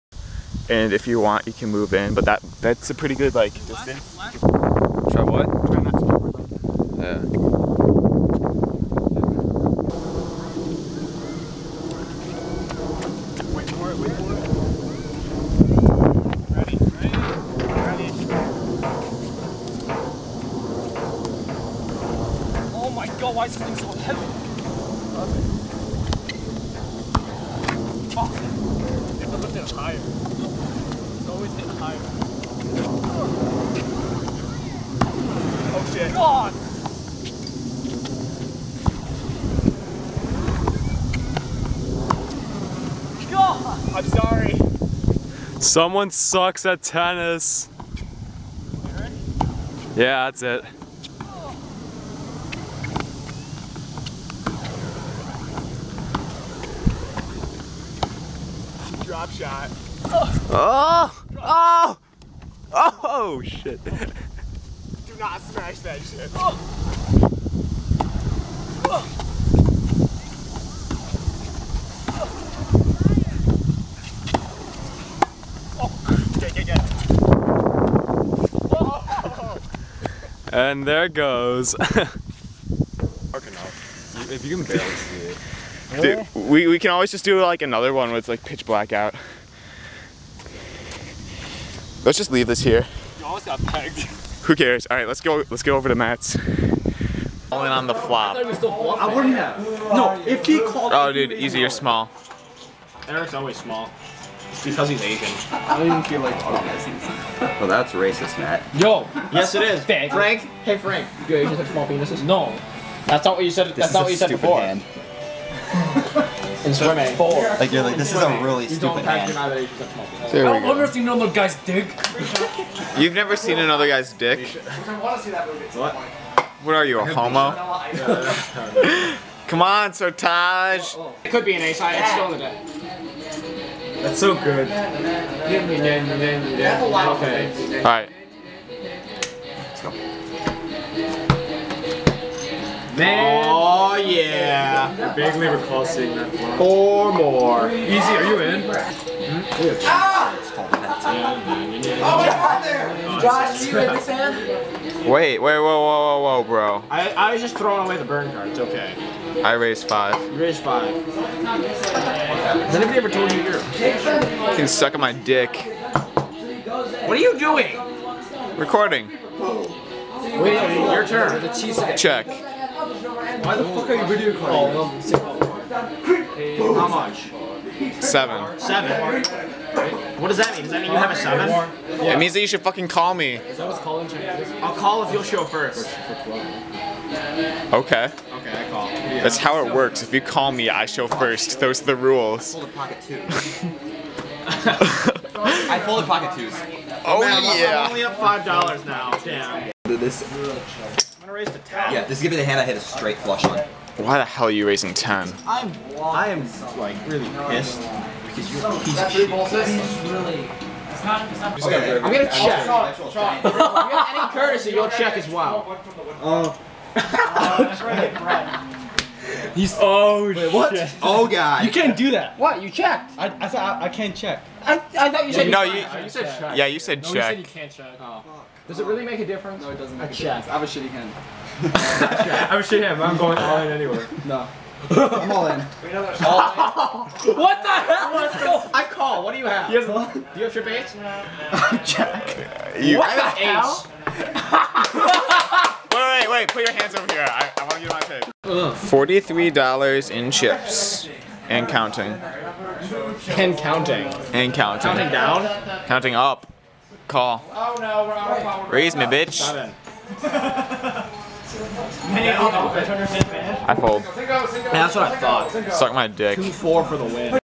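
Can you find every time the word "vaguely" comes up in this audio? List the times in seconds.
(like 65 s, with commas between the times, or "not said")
145 s.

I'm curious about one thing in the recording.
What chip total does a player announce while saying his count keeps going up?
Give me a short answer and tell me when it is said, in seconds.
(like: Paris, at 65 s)
$43, at 248 s.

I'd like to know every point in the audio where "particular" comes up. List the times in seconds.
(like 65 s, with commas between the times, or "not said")
not said.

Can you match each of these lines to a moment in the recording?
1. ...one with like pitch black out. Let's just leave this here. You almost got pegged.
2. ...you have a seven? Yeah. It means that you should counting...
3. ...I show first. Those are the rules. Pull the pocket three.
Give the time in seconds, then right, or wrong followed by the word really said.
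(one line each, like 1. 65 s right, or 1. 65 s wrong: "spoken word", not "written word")
1. 87 s right
2. 180 s wrong: "fucking", not "counting"
3. 190 s wrong: "two", not "three".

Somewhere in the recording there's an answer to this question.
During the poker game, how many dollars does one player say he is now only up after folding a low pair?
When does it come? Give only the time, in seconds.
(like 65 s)
198 s.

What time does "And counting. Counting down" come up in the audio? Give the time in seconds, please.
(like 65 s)
254 s.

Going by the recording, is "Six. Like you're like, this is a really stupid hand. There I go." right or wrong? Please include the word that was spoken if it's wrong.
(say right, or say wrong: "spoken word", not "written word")
wrong: "Four", not "Six".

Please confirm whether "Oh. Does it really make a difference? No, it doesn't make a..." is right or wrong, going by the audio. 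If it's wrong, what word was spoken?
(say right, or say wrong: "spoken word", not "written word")
right.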